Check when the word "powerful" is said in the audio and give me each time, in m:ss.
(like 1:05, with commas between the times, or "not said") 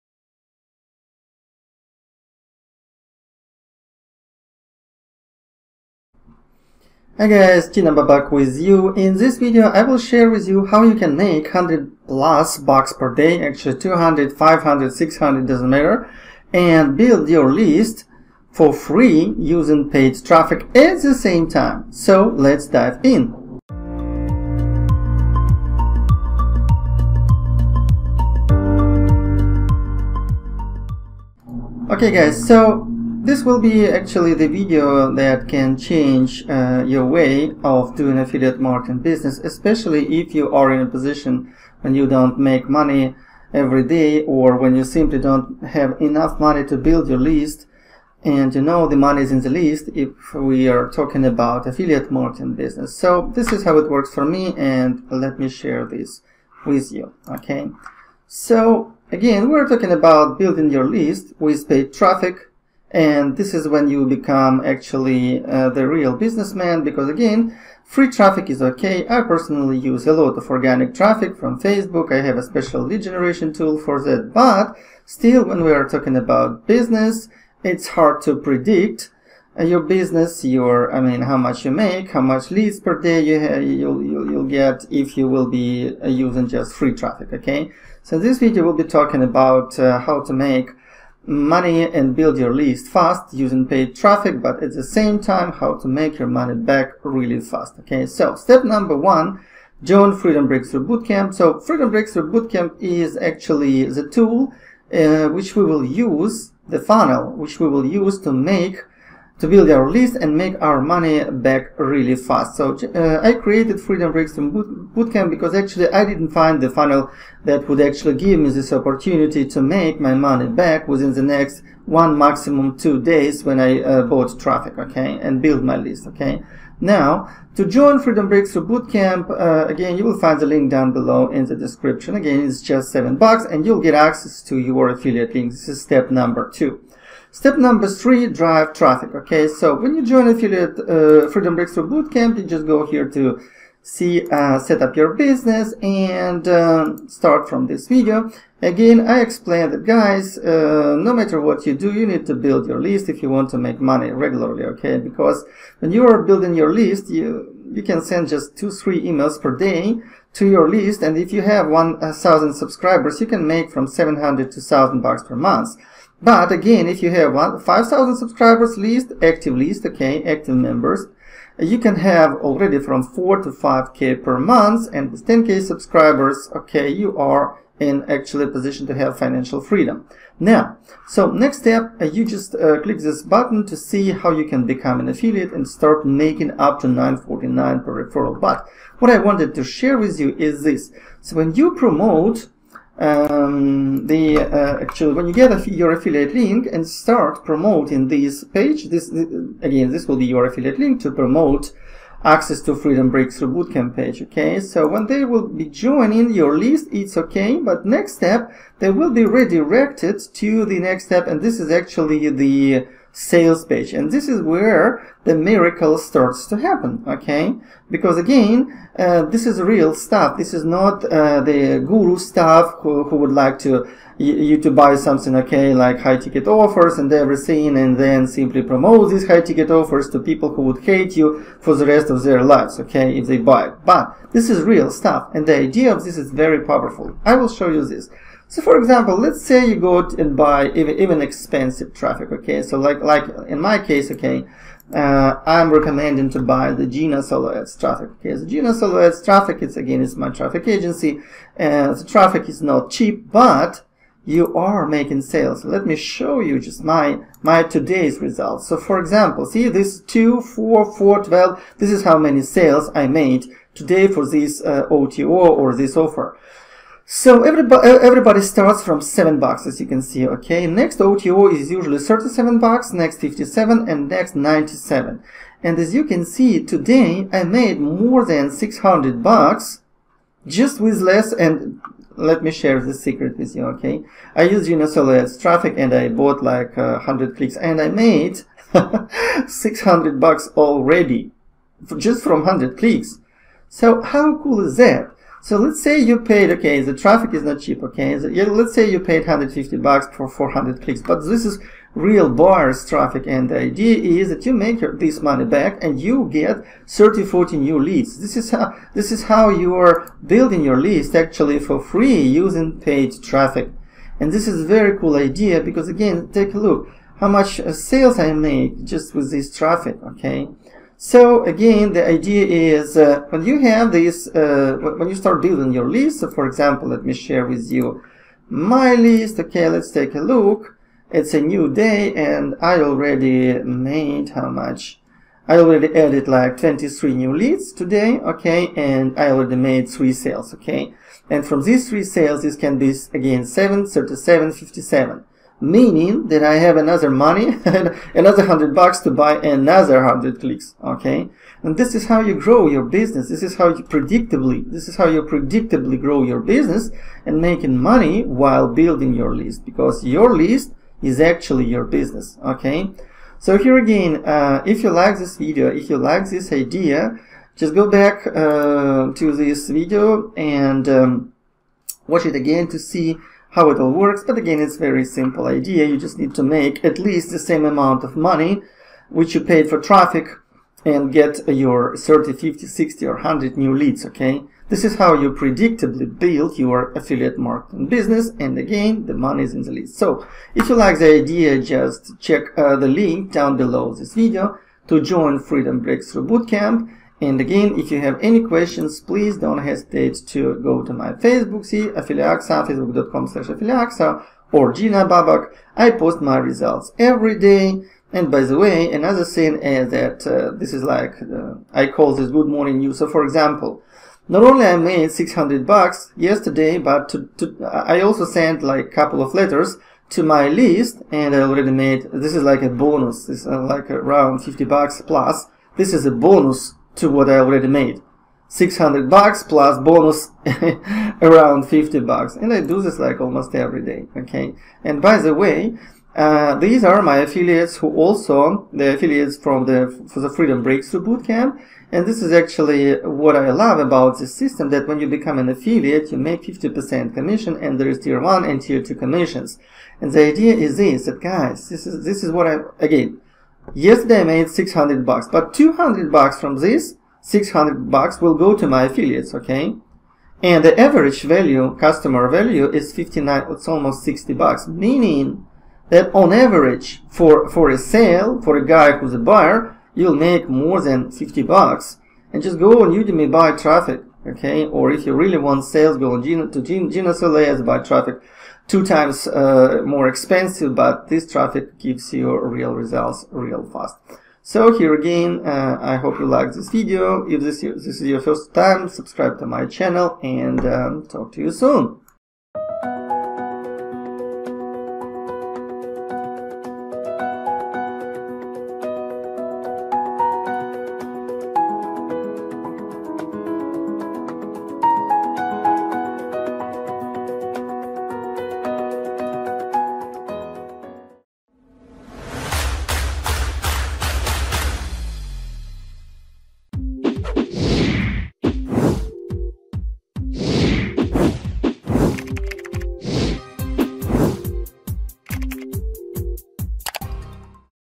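3:56.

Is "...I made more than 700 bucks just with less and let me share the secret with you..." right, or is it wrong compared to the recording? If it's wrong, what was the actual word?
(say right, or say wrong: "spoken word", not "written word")
wrong: "600", not "700".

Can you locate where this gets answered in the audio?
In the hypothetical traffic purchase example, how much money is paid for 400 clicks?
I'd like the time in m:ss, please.
4:59.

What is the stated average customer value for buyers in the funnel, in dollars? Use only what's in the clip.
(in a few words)
59.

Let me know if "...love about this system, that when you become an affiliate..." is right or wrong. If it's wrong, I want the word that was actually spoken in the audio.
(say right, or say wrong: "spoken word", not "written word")
right.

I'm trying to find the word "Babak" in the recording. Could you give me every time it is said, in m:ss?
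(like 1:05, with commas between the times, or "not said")
0:07, 6:45.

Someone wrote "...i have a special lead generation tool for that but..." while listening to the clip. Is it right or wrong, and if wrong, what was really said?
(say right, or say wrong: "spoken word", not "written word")
right.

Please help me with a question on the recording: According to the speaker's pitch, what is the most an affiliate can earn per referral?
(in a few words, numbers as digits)
949.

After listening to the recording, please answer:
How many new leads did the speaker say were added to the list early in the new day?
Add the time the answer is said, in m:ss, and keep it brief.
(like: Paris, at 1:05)
23, at 5:36.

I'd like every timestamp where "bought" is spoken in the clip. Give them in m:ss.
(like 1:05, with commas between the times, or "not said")
2:04, 4:46.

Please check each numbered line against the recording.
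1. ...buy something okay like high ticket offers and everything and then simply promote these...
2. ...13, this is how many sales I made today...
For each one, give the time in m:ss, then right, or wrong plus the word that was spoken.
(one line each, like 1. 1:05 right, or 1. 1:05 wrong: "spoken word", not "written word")
1. 3:44 right
2. 4:21 wrong: "12", not "13".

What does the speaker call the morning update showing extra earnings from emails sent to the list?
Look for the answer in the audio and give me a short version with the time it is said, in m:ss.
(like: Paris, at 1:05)
good morning news, at 6:52.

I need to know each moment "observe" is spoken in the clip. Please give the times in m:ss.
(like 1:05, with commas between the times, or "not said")
not said.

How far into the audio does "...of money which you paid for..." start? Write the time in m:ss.
6:18.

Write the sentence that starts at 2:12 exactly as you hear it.
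Again, it's just seven bucks and you'll get access to your affiliate link.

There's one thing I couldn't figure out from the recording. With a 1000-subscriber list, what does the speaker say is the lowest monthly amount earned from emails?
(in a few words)
700.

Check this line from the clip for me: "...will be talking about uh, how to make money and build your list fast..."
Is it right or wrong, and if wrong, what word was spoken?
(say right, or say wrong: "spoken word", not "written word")
right.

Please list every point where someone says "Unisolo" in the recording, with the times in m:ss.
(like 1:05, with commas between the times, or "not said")
4:44.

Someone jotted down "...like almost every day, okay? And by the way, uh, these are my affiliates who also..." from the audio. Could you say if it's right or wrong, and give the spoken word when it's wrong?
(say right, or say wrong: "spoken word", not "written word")
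right.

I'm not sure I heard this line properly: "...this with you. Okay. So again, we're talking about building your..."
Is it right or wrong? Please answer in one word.
right.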